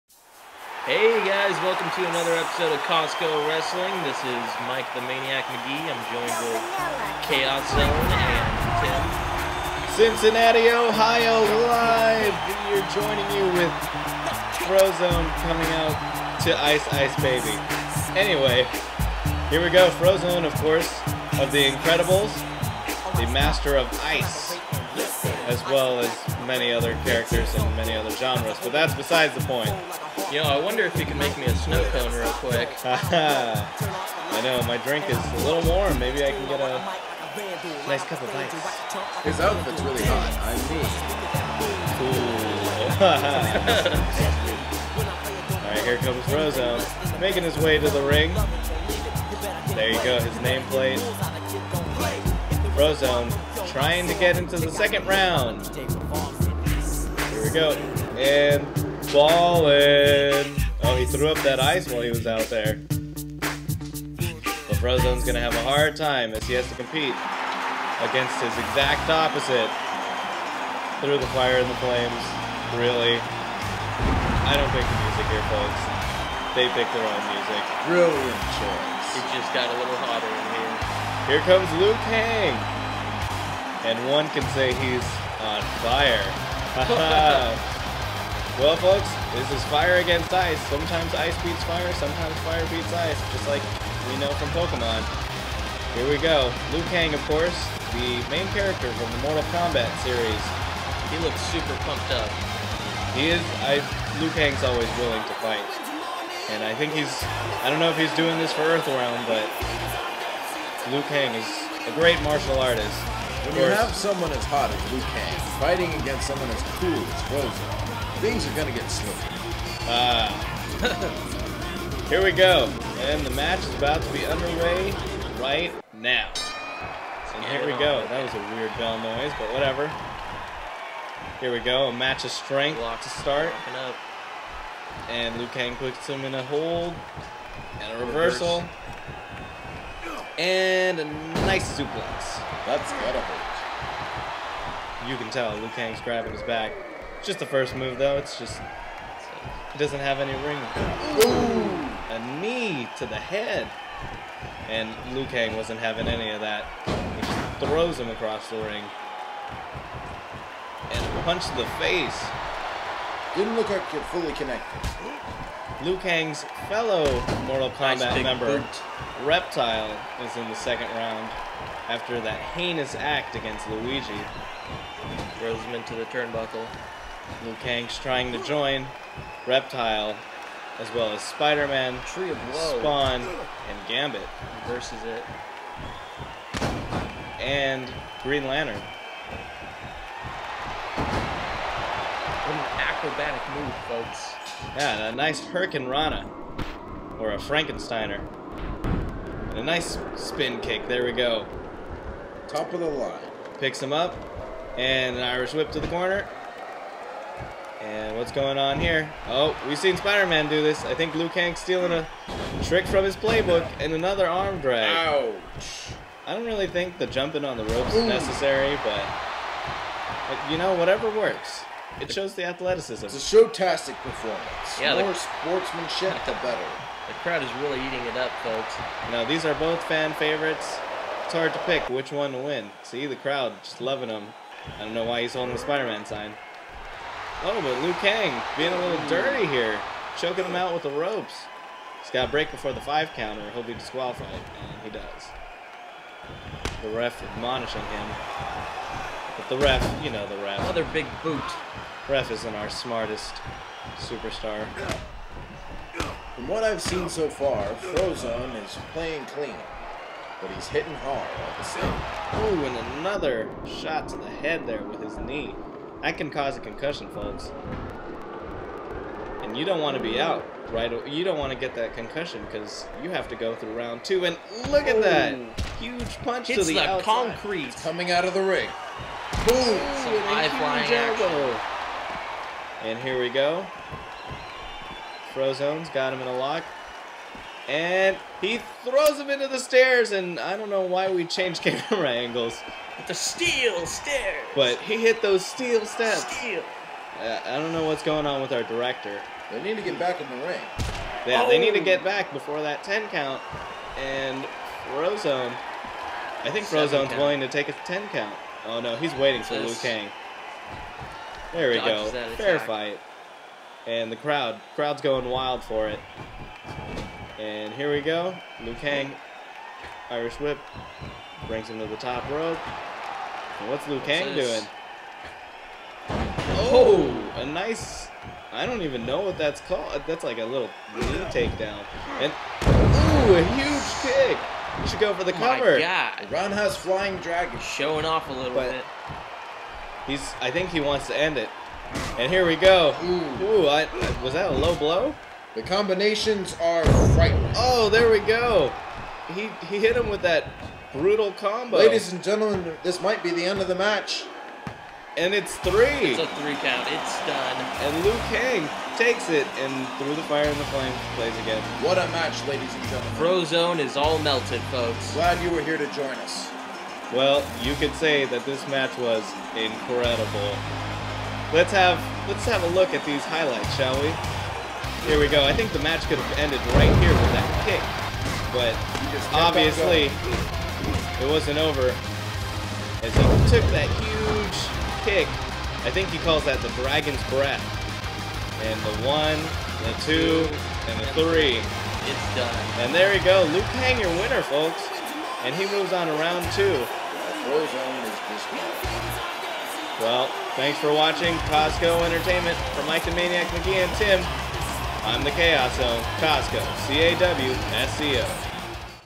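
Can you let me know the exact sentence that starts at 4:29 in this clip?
And you don't want to be out, right?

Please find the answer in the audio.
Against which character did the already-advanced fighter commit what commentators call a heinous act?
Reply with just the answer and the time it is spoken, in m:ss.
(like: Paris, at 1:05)
Luigi, at 2:53.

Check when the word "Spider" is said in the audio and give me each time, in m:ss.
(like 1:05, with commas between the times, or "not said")
3:01, 3:29, 3:55.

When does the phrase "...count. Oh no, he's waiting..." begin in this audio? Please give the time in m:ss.
5:08.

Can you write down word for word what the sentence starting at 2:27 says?
Just the first move though, it's just it doesn't have any ring.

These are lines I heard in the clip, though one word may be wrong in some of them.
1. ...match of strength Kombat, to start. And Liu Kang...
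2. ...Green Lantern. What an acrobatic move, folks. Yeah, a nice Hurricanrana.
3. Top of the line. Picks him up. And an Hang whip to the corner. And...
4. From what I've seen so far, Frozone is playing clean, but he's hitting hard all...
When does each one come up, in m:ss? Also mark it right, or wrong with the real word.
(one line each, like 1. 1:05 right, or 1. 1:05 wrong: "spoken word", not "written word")
1. 2:11 wrong: "Block", not "Kombat"
2. 3:08 right
3. 3:22 wrong: "Irish", not "Hang"
4. 4:16 right.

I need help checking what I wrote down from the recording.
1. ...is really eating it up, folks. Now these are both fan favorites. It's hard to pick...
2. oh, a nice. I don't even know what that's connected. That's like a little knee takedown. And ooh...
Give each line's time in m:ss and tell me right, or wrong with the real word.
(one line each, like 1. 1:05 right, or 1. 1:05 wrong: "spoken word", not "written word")
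1. 3:47 right
2. 5:27 wrong: "called", not "connected".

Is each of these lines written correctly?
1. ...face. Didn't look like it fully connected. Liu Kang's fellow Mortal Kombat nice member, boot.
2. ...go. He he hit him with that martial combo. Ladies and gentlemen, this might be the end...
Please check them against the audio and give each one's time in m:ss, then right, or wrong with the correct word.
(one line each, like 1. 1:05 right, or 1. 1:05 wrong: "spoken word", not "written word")
1. 2:41 right
2. 5:48 wrong: "brutal", not "martial".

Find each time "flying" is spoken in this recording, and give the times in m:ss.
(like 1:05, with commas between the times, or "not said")
4:40, 5:36.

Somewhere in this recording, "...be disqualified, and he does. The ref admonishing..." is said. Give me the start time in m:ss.
4:03.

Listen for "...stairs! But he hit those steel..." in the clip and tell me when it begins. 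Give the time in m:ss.
4:53.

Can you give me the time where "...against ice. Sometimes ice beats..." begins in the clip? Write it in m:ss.
1:29.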